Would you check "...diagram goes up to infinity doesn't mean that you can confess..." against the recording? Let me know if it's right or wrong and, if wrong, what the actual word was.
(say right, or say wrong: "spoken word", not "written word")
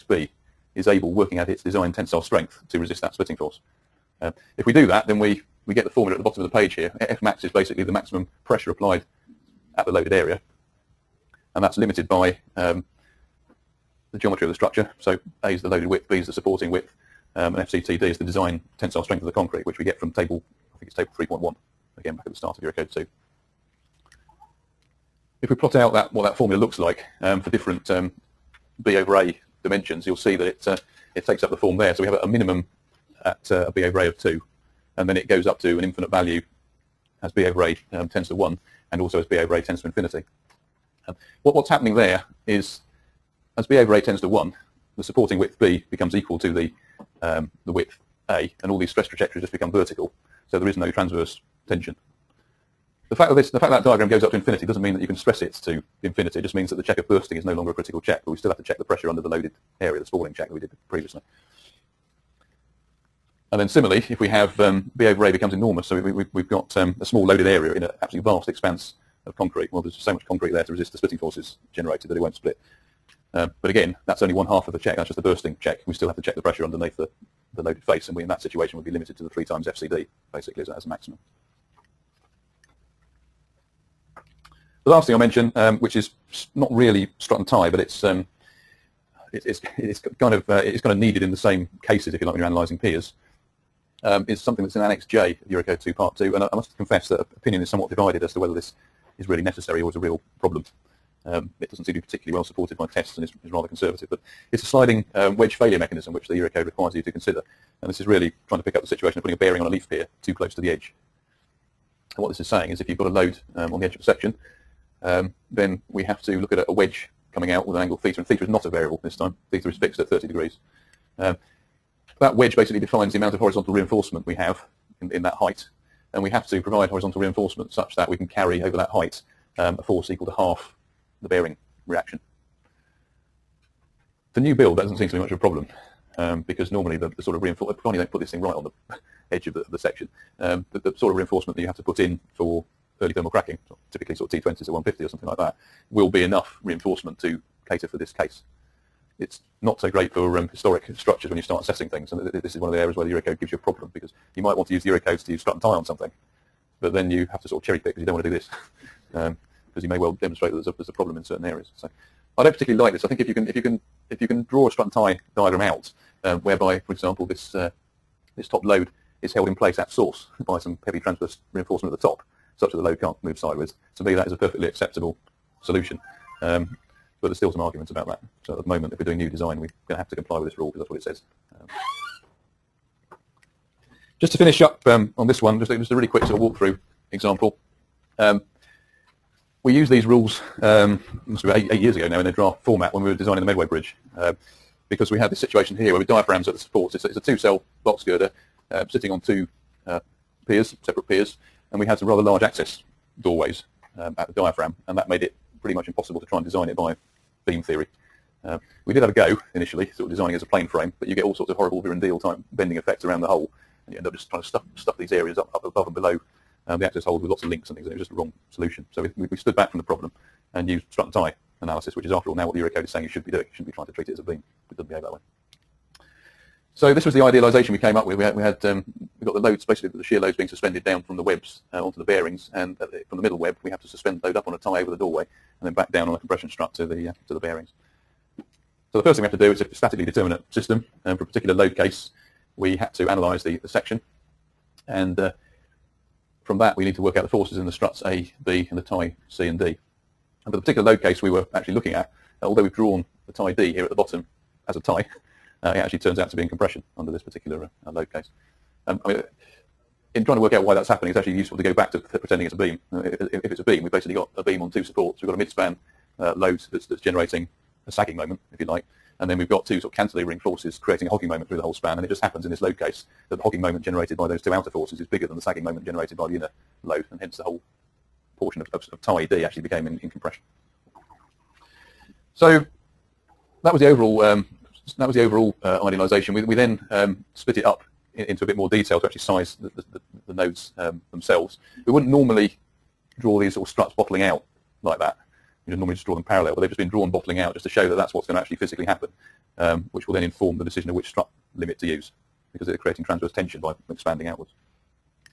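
wrong: "stress", not "confess".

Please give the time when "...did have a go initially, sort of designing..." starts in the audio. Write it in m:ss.
3:28.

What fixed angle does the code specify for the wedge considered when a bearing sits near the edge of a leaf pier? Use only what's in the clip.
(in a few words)
30 degrees.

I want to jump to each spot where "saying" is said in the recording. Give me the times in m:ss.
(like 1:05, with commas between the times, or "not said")
1:52, 3:42.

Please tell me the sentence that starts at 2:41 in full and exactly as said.
So I don't particularly like this.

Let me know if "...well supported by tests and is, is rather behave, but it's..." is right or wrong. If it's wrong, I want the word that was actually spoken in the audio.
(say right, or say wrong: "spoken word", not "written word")
wrong: "conservative", not "behave".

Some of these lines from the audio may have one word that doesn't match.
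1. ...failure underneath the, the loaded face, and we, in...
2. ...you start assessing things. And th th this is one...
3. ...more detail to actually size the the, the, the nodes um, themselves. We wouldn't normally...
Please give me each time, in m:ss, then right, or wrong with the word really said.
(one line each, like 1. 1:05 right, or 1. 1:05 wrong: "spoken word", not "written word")
1. 1:16 wrong: "pressure", not "failure"
2. 2:31 right
3. 4:48 right.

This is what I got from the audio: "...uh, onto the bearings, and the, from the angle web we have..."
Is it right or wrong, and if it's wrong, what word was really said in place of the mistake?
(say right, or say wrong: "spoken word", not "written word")
wrong: "middle", not "angle".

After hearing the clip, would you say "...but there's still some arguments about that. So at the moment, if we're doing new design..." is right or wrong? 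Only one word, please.
right.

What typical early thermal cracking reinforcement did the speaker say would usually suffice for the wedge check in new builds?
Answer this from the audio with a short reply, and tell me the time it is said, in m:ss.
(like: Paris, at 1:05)
T20s at 150, at 2:24.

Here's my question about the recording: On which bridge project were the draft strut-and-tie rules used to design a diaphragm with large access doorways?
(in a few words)
Medway Bridge.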